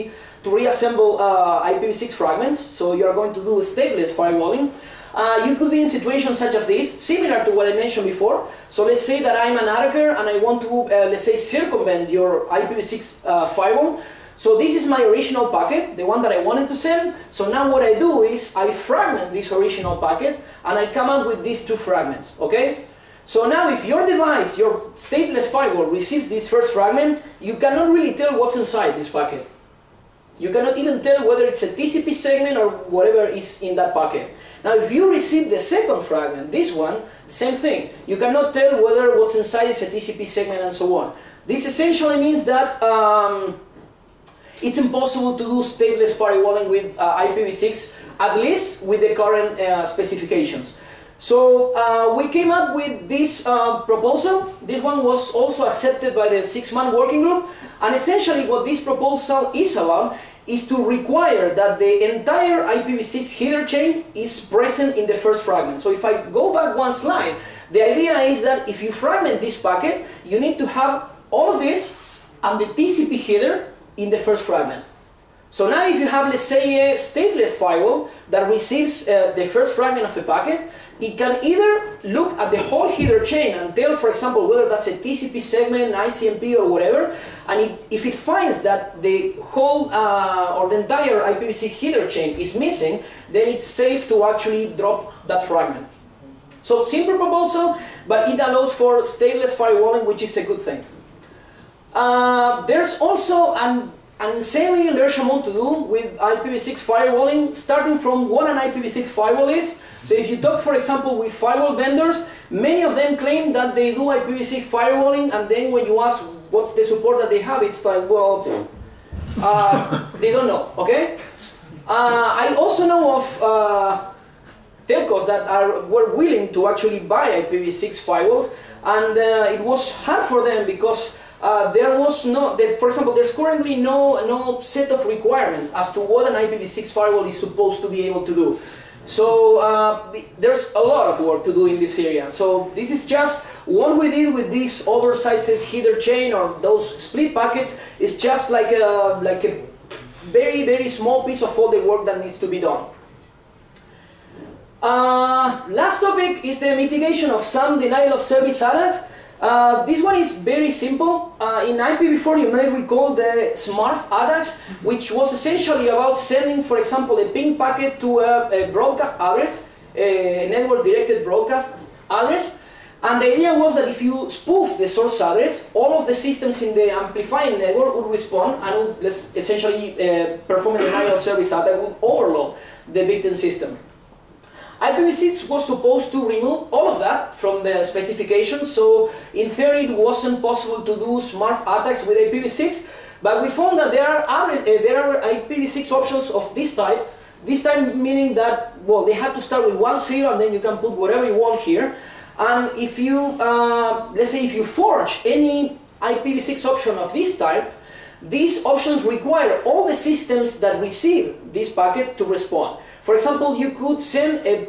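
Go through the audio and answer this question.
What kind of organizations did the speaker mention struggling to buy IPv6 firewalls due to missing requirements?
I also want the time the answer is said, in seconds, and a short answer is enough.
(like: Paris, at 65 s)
Telcos, at 124 s.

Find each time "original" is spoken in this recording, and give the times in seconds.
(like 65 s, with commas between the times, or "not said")
15 s, 19 s.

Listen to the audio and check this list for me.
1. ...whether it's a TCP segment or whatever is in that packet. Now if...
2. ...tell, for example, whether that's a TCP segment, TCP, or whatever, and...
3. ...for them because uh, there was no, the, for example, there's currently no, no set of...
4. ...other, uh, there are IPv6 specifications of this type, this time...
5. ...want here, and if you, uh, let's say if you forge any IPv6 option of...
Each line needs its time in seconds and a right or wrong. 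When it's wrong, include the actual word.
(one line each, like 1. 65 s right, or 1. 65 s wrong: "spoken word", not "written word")
1. 31 s right
2. 83 s wrong: "ICMP", not "TCP"
3. 130 s right
4. 194 s wrong: "options", not "specifications"
5. 201 s right.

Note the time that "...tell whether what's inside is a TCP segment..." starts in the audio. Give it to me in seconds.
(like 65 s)
38 s.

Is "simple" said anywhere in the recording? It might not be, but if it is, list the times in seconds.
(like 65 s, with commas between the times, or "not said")
96 s, 160 s.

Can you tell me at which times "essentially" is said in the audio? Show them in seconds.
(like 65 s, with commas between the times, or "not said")
41 s, 57 s, 165 s, 179 s.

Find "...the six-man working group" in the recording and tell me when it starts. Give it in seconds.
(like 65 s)
56 s.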